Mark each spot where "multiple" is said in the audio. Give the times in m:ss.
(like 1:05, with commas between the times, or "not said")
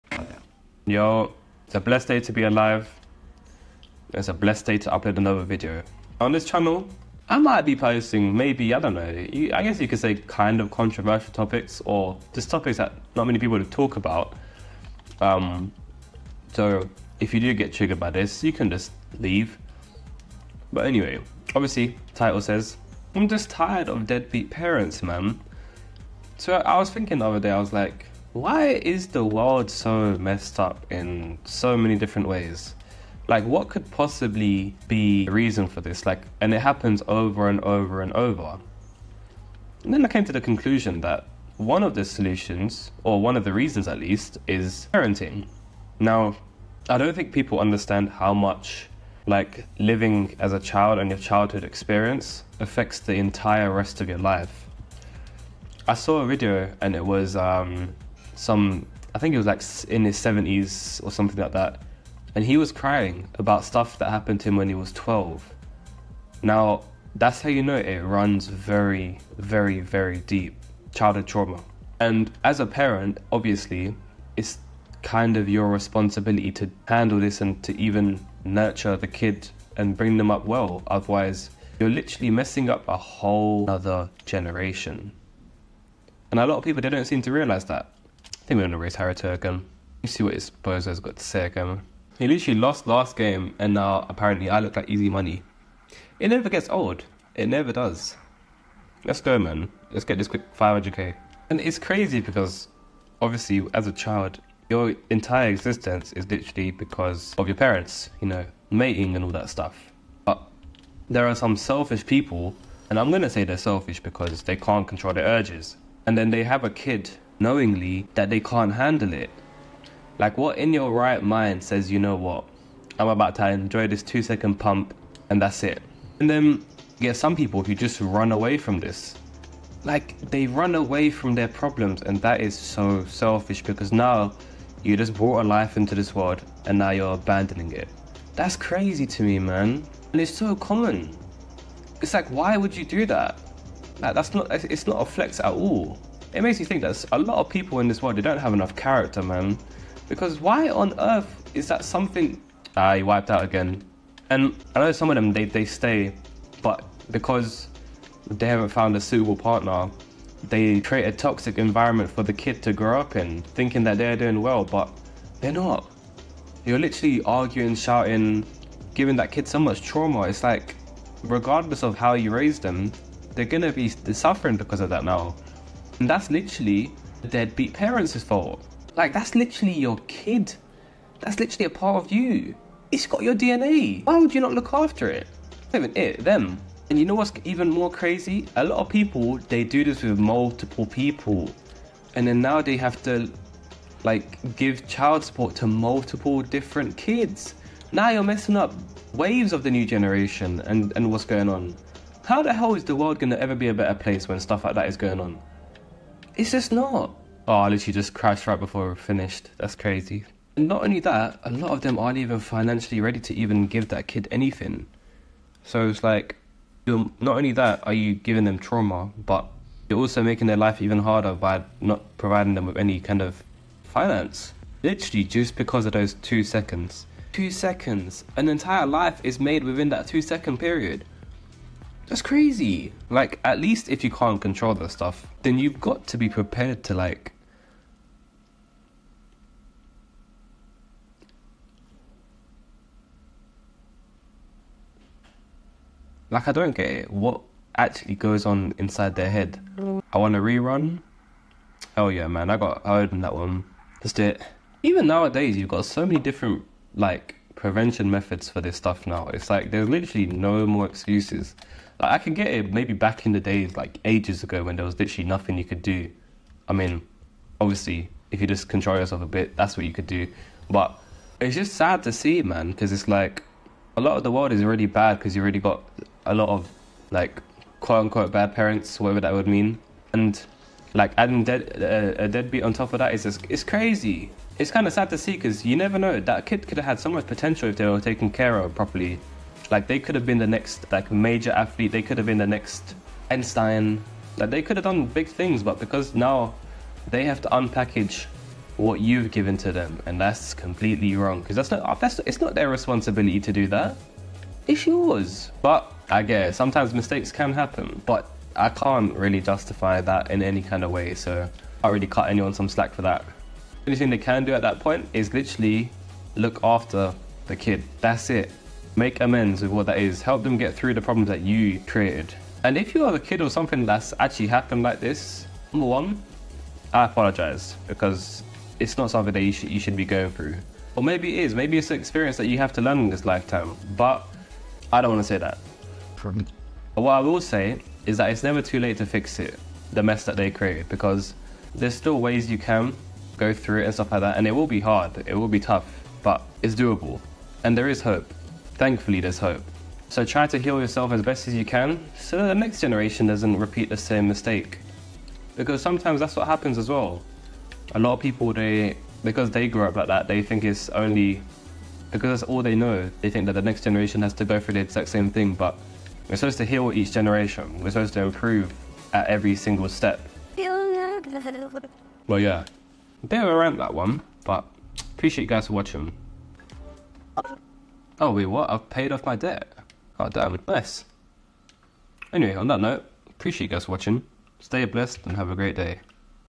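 3:10, 3:15.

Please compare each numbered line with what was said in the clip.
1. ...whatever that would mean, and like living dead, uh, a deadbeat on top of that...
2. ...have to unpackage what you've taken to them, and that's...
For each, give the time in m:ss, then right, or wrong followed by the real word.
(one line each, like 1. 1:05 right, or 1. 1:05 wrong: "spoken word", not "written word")
1. 4:38 wrong: "adding", not "living"
2. 4:57 wrong: "given", not "taken".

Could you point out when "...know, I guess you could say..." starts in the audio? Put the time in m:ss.
0:08.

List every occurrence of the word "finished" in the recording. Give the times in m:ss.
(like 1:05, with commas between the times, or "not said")
3:28.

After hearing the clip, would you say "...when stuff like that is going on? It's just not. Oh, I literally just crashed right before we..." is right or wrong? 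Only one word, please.
right.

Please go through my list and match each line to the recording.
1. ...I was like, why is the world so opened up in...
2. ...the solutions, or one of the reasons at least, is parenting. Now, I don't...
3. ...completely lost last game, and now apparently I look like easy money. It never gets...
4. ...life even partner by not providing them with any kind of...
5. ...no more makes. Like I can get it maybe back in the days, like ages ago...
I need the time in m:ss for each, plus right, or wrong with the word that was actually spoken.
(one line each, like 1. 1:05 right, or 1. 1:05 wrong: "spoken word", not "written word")
1. 0:27 wrong: "messed", not "opened"
2. 0:41 right
3. 1:32 wrong: "literally", not "completely"
4. 3:40 wrong: "harder", not "partner"
5. 4:20 wrong: "excuses", not "makes".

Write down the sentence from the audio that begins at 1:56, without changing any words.
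And then they have a kid knowingly that they can't handle it.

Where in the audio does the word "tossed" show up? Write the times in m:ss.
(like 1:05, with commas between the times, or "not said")
not said.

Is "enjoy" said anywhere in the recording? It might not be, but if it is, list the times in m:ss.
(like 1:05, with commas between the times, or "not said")
2:03.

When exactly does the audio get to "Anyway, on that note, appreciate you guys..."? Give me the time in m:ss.
6:22.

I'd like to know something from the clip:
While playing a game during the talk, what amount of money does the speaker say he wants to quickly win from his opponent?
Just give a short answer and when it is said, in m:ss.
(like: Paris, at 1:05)
500k, at 1:40.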